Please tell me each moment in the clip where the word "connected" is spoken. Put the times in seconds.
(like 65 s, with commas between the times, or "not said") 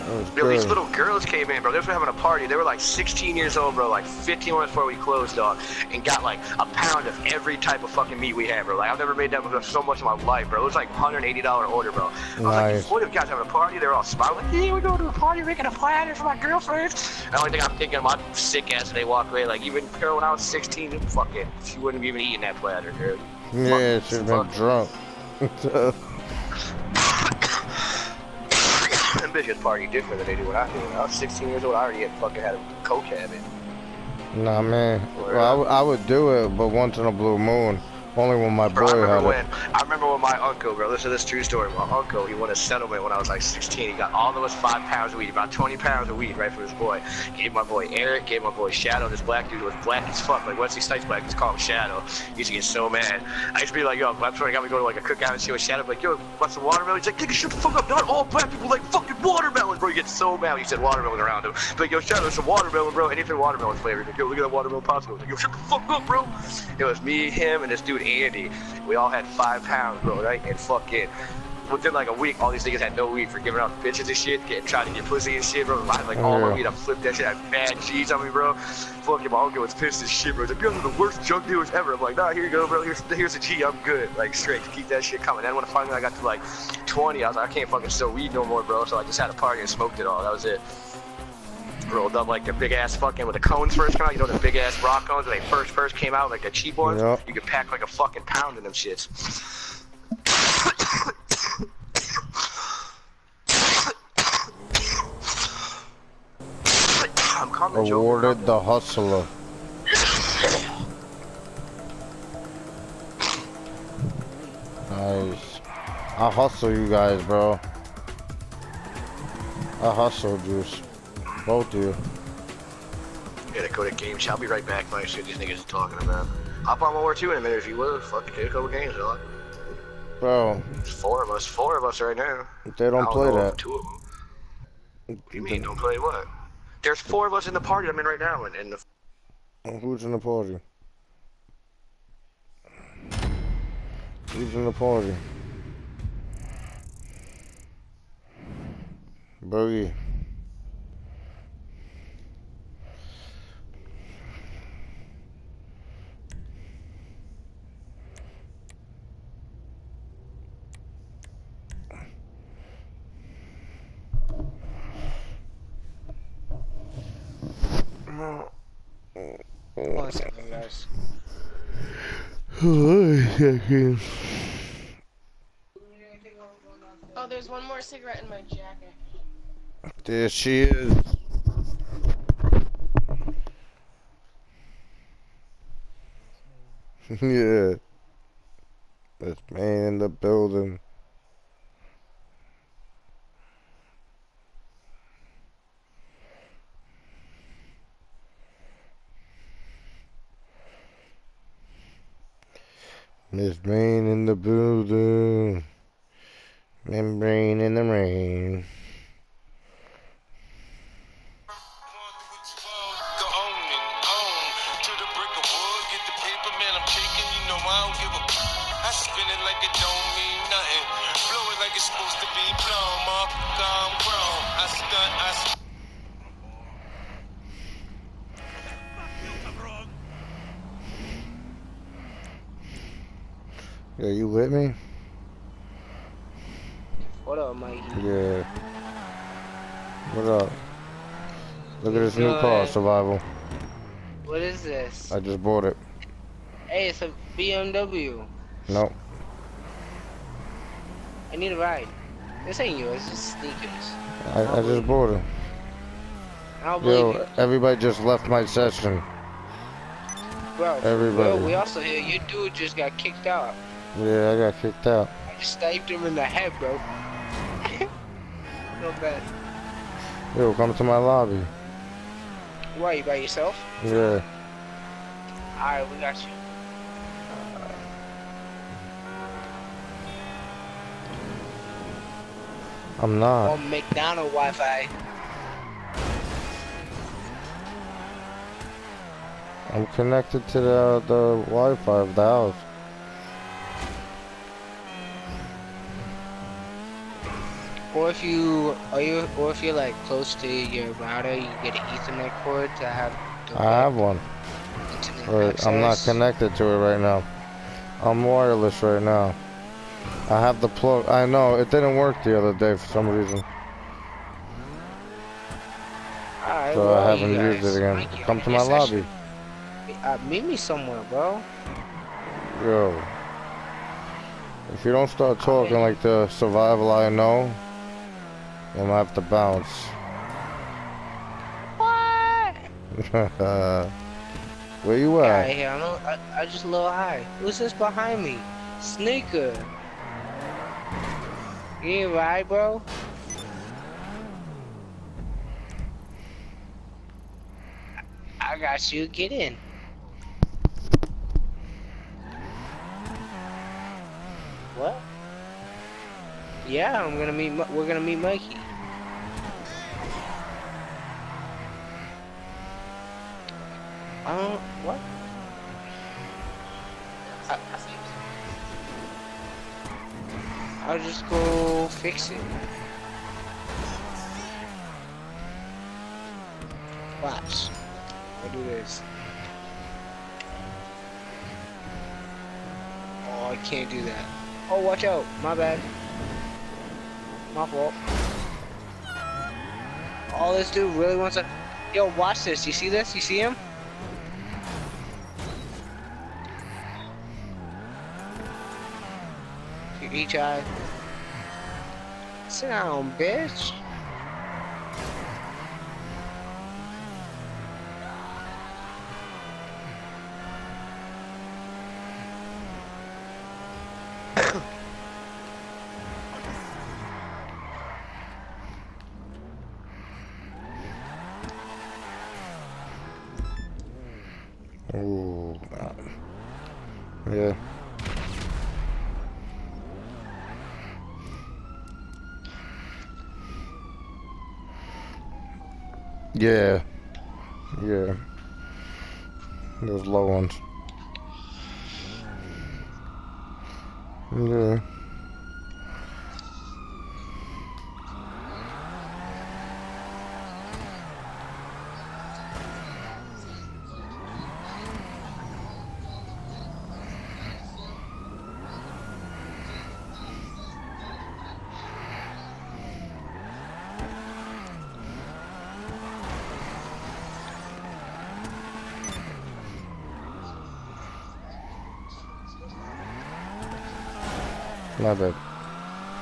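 289 s, 306 s.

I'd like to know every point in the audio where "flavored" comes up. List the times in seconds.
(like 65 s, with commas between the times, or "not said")
63 s.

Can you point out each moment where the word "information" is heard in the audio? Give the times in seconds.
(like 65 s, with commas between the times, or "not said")
not said.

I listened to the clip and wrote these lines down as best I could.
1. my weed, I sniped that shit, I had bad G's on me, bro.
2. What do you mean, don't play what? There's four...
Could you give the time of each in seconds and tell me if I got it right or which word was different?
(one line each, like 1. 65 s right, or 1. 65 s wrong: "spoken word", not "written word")
1. 76 s wrong: "flipped", not "sniped"
2. 135 s right.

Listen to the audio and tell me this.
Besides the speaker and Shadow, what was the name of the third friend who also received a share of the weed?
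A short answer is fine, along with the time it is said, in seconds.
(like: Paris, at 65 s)
Andy, at 68 s.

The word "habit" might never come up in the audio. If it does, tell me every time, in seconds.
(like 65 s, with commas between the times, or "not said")
33 s.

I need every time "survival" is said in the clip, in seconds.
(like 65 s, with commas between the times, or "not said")
242 s, 326 s.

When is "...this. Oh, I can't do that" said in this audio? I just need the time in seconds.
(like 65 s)
378 s.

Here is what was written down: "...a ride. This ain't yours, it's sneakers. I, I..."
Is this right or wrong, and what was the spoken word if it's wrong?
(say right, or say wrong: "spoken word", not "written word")
right.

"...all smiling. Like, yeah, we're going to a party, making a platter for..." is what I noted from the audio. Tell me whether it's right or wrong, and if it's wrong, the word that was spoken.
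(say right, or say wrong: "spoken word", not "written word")
right.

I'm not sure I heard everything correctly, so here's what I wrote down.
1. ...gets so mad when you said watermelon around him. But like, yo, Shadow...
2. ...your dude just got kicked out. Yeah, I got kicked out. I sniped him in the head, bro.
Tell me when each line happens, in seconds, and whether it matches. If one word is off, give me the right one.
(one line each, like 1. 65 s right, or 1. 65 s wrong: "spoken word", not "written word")
1. 59 s right
2. 261 s right.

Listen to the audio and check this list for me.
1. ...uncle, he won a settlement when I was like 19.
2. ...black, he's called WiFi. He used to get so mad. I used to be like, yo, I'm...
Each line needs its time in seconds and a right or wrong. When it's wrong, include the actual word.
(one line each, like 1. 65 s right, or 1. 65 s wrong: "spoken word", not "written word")
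1. 41 s wrong: "16", not "19"
2. 51 s wrong: "Shadow", not "WiFi".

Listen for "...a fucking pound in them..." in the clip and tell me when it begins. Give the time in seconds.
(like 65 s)
97 s.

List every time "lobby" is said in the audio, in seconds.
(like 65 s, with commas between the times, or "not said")
270 s, 318 s.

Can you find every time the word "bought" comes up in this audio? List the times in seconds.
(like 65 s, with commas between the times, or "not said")
245 s, 254 s.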